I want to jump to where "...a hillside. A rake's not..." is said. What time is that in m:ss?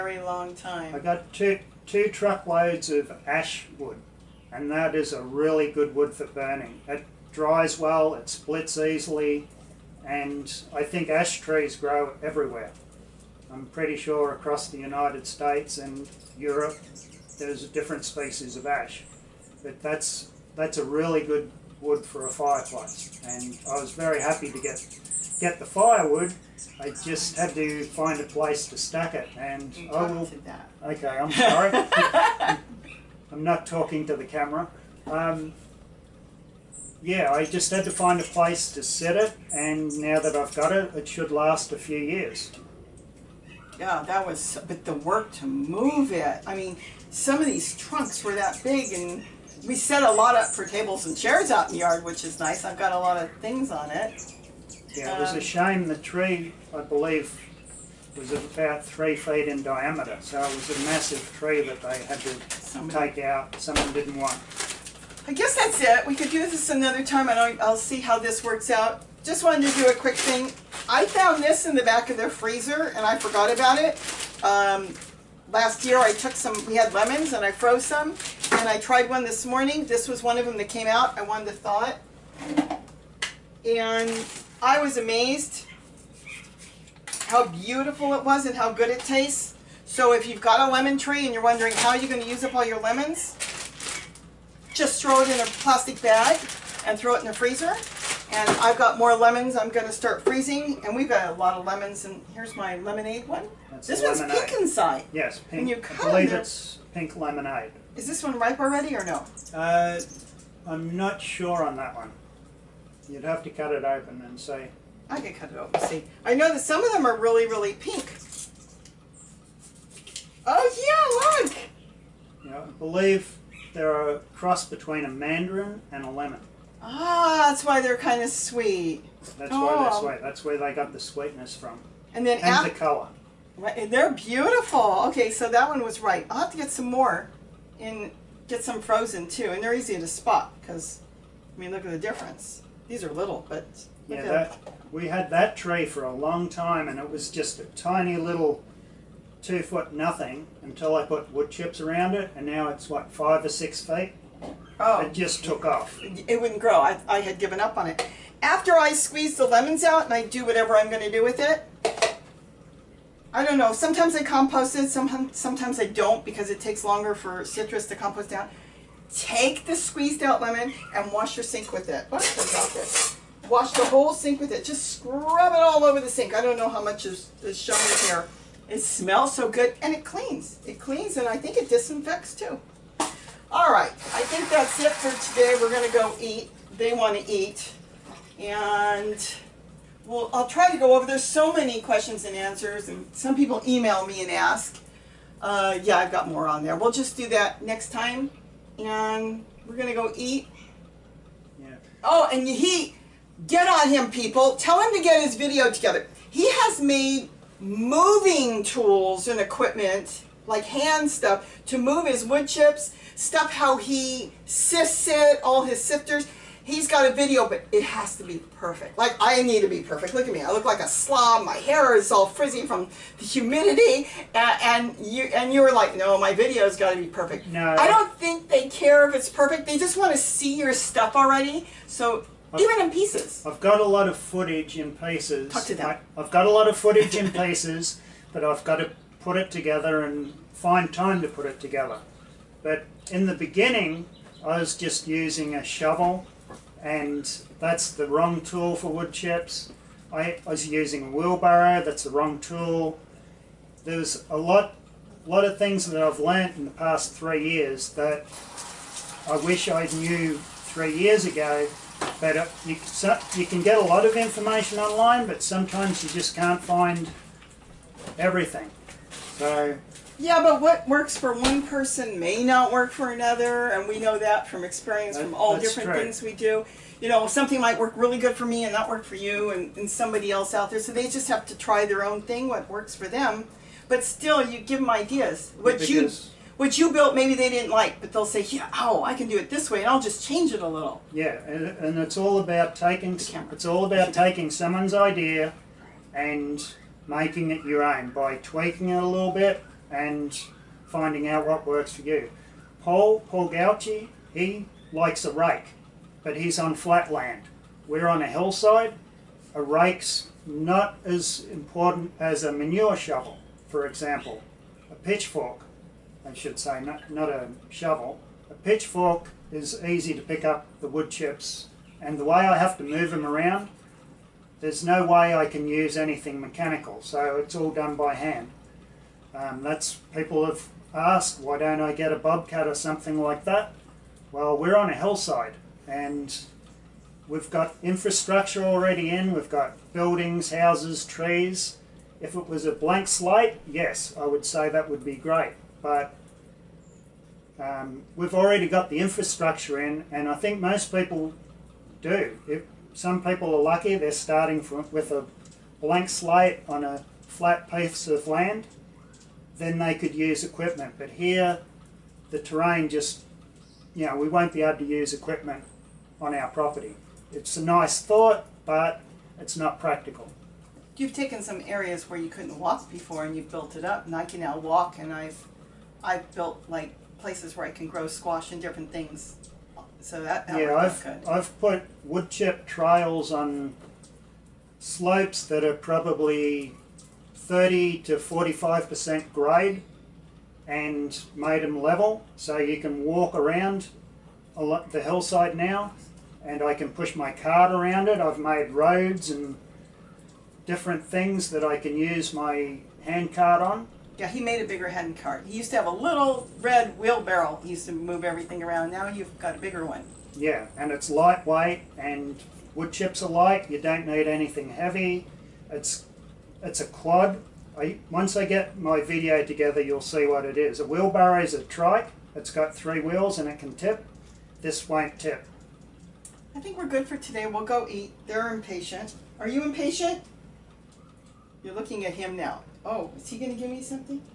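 5:08.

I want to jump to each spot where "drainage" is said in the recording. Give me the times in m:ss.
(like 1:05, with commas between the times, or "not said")
not said.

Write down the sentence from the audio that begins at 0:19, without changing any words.
But that's that's a really good wood for a fireplace and I was very happy to get get the firewood.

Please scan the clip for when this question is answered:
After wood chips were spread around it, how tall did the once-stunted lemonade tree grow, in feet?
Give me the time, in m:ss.
2:33.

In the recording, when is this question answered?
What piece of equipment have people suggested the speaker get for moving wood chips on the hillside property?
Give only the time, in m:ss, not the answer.
5:32.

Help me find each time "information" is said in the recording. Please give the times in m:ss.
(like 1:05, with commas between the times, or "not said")
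4:24.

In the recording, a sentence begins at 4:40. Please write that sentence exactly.
So they just have to try their own thing, what works for them.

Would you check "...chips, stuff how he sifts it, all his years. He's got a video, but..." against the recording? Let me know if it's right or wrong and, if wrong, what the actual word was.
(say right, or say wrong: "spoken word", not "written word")
wrong: "sifters", not "years".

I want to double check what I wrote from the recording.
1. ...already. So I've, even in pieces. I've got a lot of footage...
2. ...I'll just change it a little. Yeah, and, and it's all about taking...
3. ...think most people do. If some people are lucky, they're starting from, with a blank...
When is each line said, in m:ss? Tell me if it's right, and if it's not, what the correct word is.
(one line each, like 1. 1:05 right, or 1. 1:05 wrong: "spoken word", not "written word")
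1. 3:51 right
2. 4:49 right
3. 5:50 right.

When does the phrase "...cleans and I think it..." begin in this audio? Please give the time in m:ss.
3:00.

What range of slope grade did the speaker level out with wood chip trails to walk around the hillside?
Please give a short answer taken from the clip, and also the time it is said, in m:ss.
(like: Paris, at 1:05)
30 to 45 percent, at 6:27.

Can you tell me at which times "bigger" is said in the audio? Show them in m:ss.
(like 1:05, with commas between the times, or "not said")
6:44, 6:49.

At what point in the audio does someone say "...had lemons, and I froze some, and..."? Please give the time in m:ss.
1:16.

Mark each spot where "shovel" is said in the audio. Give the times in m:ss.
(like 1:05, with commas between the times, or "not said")
4:05, 5:12, 5:17.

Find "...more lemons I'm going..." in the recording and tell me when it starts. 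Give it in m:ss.
1:38.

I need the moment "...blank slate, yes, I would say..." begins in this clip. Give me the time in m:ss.
5:42.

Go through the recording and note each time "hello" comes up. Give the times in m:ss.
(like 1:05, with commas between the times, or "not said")
not said.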